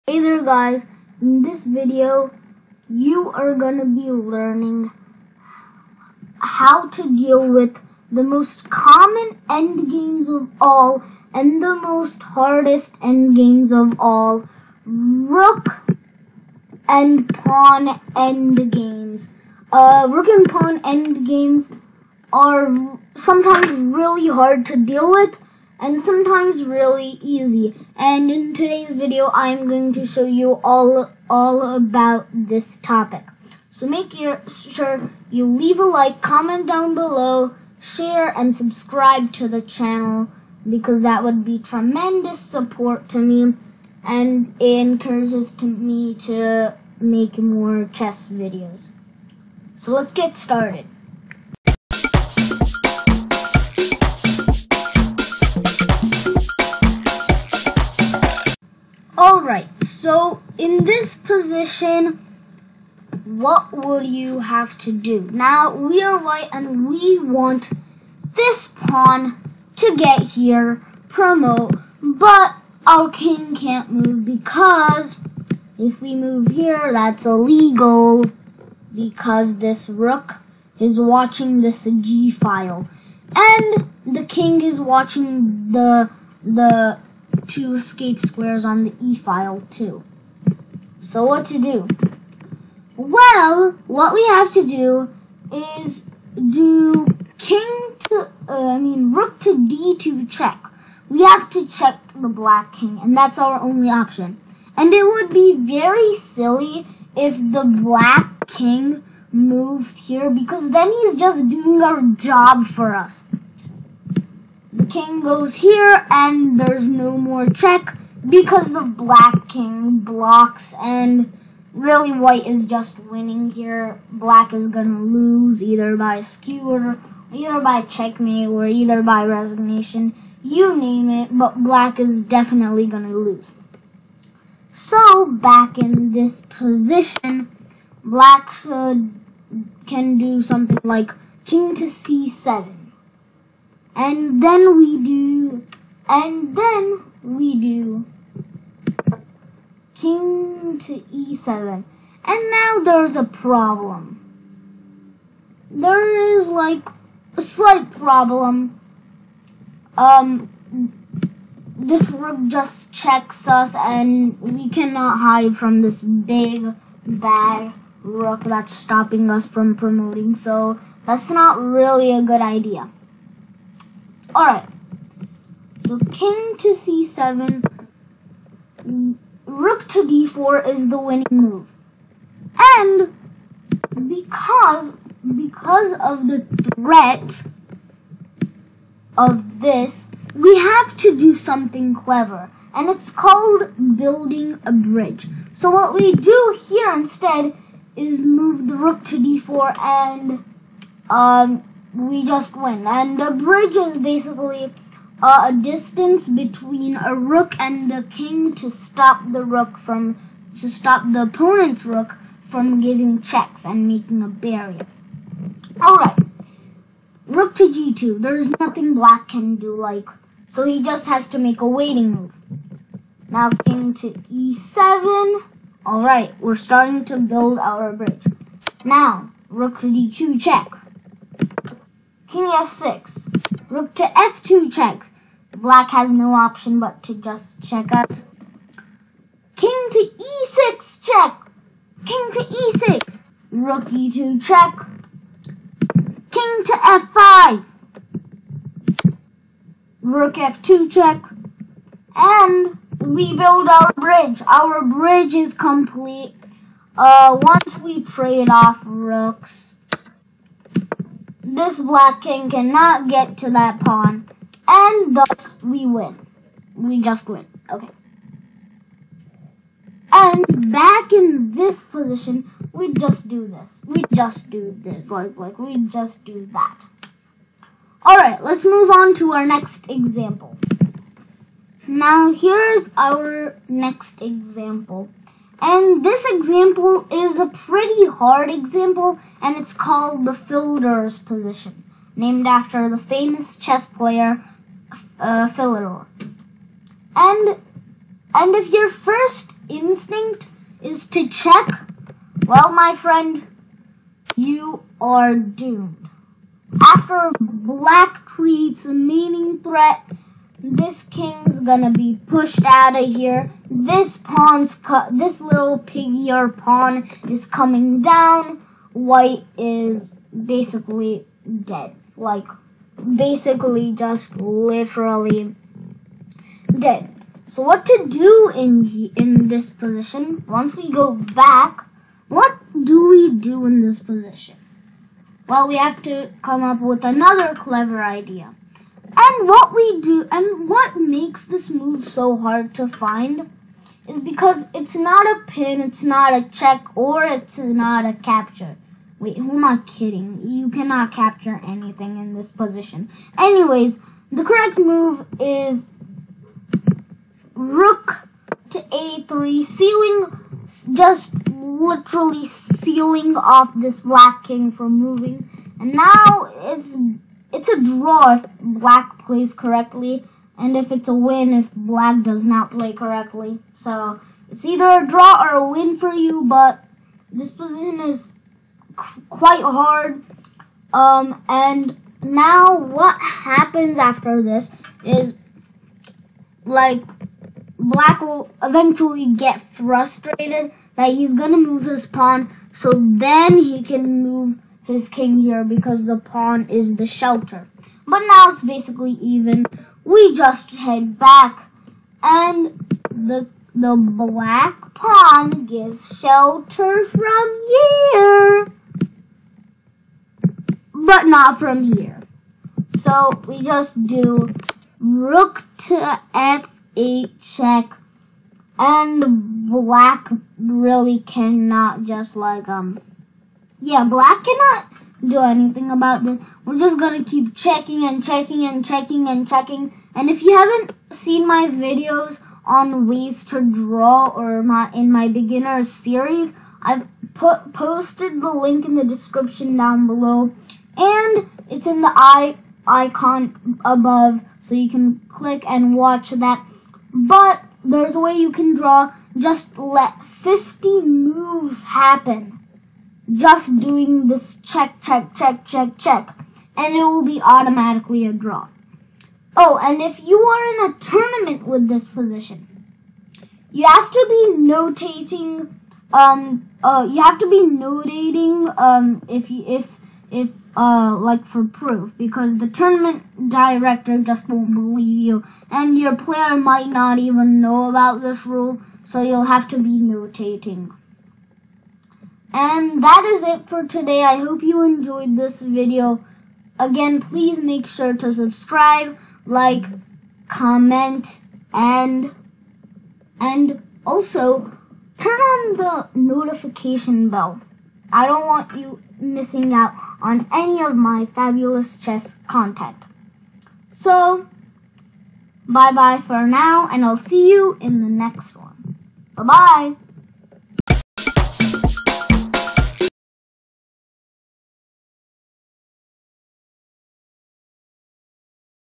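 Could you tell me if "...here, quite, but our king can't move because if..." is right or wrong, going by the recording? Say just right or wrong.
wrong.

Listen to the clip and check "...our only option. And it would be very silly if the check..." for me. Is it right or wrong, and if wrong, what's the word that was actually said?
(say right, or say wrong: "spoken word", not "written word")
wrong: "black", not "check".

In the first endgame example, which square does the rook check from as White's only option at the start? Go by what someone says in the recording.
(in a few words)
d2.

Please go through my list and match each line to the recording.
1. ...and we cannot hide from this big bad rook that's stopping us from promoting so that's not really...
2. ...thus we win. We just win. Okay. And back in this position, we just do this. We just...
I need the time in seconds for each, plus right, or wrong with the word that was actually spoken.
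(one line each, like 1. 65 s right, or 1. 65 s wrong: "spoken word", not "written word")
1. 163 s right
2. 265 s right.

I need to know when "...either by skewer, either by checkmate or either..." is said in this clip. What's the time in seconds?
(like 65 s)
125 s.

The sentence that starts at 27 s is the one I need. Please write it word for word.
And in today's video, I'm going to show you all, all about this topic.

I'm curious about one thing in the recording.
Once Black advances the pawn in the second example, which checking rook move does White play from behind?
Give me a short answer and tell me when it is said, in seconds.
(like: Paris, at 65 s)
Rook to f8, at 414 s.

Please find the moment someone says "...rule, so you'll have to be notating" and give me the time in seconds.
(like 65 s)
478 s.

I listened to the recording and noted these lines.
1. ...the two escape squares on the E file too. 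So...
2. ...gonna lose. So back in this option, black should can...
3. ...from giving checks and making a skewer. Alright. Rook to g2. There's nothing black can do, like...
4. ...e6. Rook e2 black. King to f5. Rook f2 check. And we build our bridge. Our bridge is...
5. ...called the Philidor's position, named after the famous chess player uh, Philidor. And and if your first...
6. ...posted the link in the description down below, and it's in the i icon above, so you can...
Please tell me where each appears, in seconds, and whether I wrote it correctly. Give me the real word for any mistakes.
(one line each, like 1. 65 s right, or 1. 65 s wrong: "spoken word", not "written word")
1. 86 s right
2. 132 s wrong: "position", not "option"
3. 212 s wrong: "barrier", not "skewer"
4. 242 s wrong: "check", not "black"
5. 289 s right
6. 437 s right.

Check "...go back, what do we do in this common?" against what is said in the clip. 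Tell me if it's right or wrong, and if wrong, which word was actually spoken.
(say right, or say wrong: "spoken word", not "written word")
wrong: "position", not "common".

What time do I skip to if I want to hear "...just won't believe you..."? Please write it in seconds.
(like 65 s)
474 s.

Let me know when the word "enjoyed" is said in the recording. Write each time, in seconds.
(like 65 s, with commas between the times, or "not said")
484 s.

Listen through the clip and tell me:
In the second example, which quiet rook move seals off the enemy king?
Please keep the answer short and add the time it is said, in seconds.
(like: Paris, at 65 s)
Rook to a3, at 357 s.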